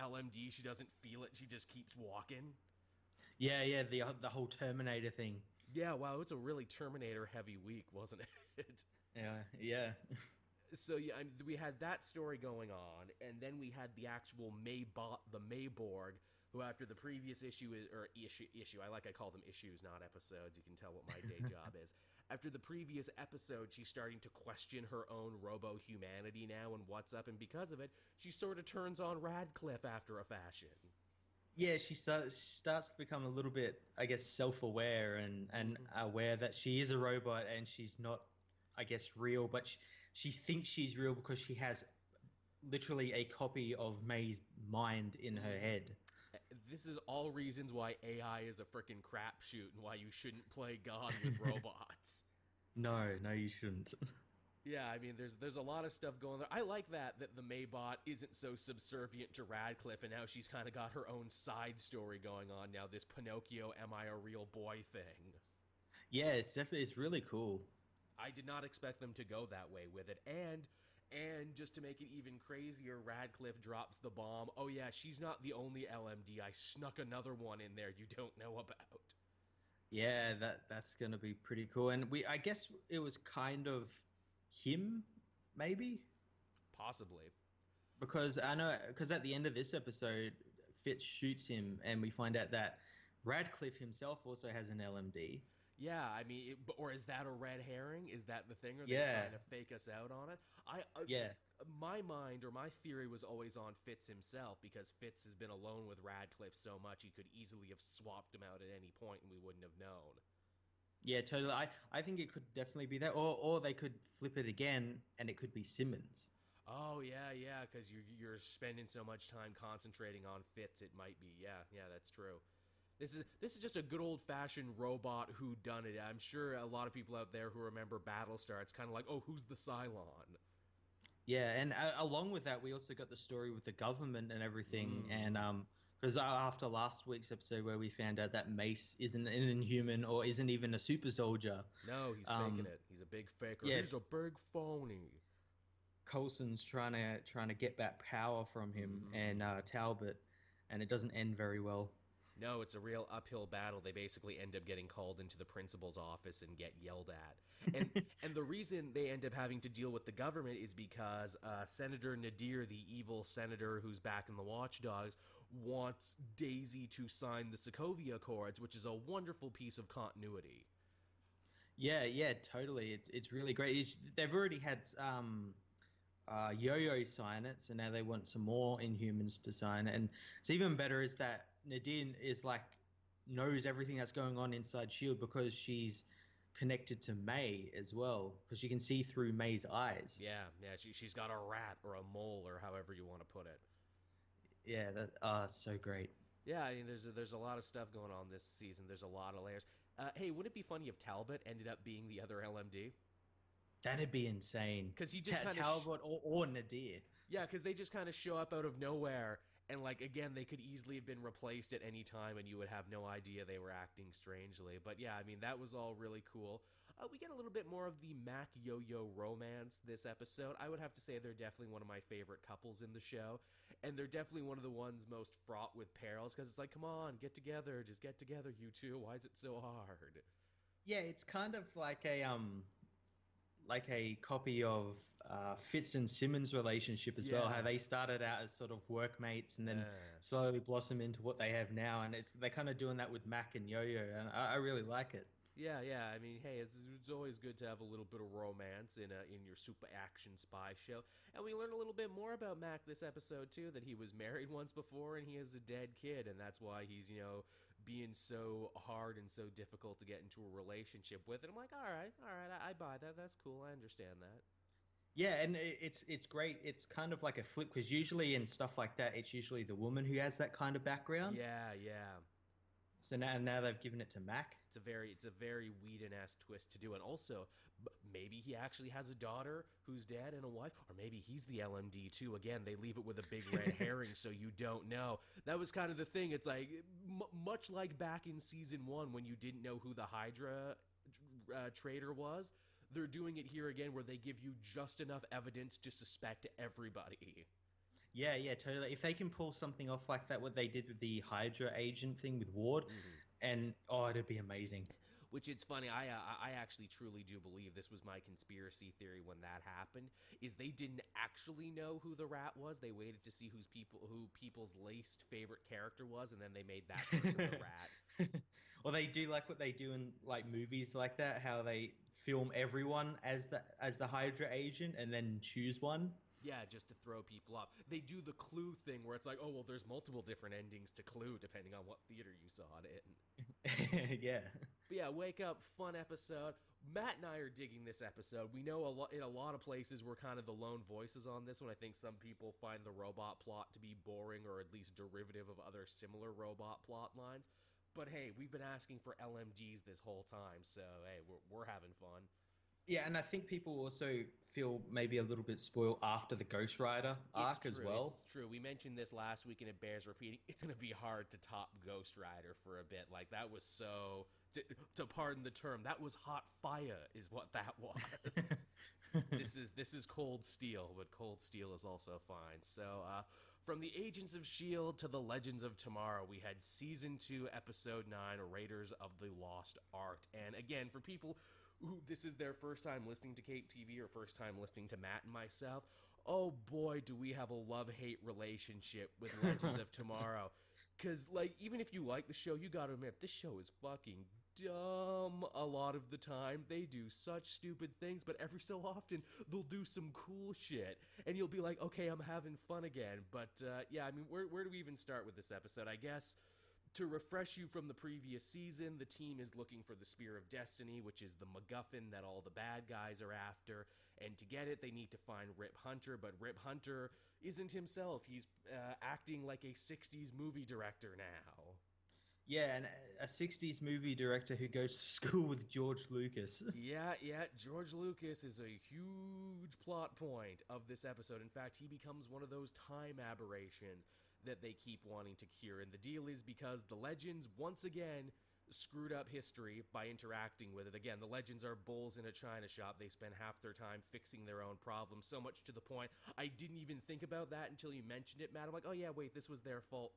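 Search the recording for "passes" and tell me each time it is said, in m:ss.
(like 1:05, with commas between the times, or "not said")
not said.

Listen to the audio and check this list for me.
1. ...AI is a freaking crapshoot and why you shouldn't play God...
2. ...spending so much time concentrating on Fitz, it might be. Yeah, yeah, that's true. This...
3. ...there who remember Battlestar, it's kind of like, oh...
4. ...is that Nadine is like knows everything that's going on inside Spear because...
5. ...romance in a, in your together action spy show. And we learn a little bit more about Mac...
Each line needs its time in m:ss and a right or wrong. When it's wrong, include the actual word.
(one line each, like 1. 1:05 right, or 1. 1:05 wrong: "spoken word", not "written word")
1. 0:48 right
2. 1:58 right
3. 2:07 right
4. 3:01 wrong: "Shield", not "Spear"
5. 4:08 wrong: "super", not "together".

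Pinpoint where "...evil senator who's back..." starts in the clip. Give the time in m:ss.
2:42.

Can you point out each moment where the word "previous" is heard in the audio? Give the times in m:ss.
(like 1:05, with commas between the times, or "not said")
0:16, 0:22, 6:47.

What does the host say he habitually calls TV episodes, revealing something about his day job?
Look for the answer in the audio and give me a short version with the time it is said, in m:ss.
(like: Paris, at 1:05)
issues, at 0:19.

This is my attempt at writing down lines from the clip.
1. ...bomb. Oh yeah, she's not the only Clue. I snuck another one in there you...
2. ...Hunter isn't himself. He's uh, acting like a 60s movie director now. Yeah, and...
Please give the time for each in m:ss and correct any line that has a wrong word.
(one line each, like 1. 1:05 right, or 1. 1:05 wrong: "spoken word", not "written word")
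1. 1:14 wrong: "LMD", not "Clue"
2. 6:56 right.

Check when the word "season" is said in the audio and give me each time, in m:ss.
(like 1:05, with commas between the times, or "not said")
3:18, 4:48, 6:16, 6:48.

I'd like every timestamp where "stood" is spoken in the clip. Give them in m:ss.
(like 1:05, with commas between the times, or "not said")
not said.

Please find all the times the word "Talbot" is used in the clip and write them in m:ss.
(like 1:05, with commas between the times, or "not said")
2:29, 3:20, 3:25.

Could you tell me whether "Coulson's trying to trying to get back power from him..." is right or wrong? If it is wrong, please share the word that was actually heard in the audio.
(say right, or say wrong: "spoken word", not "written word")
right.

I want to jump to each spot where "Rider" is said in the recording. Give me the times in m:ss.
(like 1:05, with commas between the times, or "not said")
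5:56, 6:02.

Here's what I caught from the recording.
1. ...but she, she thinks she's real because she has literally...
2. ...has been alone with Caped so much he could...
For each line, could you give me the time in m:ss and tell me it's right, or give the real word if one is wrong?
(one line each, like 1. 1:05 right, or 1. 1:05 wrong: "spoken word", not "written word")
1. 0:39 right
2. 1:45 wrong: "Radcliffe", not "Caped".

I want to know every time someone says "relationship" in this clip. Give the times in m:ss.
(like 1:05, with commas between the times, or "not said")
3:56, 4:20, 6:28.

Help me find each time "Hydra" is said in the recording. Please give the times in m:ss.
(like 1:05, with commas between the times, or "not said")
4:50, 5:01, 5:24.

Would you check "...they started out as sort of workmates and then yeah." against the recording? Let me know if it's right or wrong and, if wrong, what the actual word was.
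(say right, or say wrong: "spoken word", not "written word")
right.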